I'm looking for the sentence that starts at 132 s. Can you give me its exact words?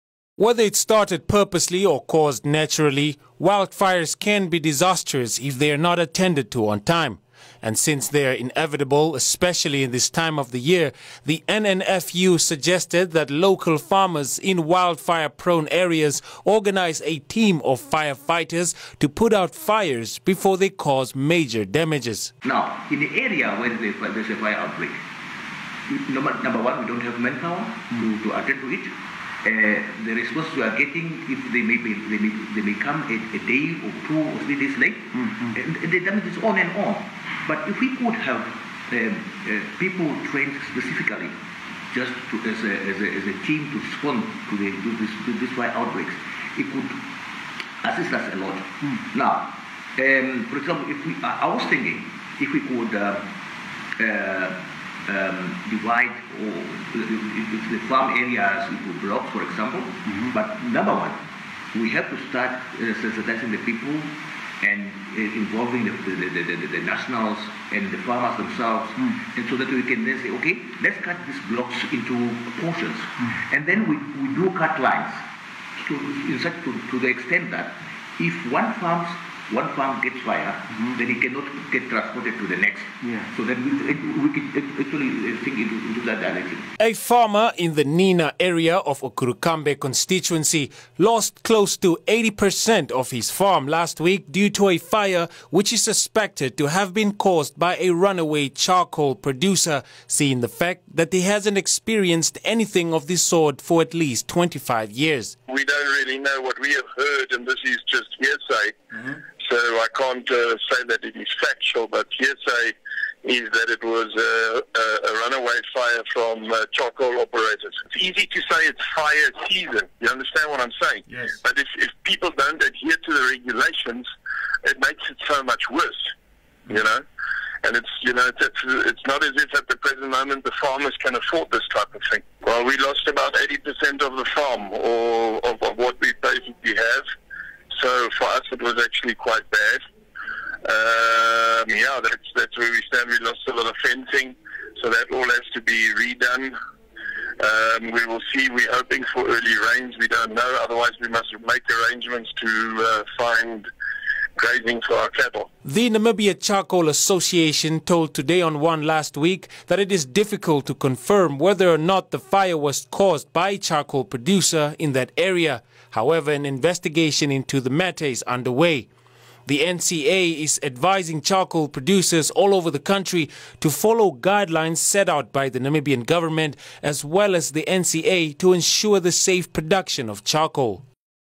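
Well, we lost about 80% of the farm or of, of what we basically have.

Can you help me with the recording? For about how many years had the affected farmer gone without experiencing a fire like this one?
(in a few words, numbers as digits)
25 years.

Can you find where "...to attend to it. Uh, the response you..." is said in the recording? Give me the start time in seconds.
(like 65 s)
28 s.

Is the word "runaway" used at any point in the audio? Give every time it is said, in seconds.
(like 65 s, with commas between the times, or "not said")
97 s, 115 s.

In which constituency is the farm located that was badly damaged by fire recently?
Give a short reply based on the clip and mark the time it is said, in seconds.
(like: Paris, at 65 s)
Okurukambe, at 89 s.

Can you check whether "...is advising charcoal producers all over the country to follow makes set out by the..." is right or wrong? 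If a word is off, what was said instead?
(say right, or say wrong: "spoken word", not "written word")
wrong: "guidelines", not "makes".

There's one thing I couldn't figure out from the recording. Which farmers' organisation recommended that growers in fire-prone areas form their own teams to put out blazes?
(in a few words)
NNFU.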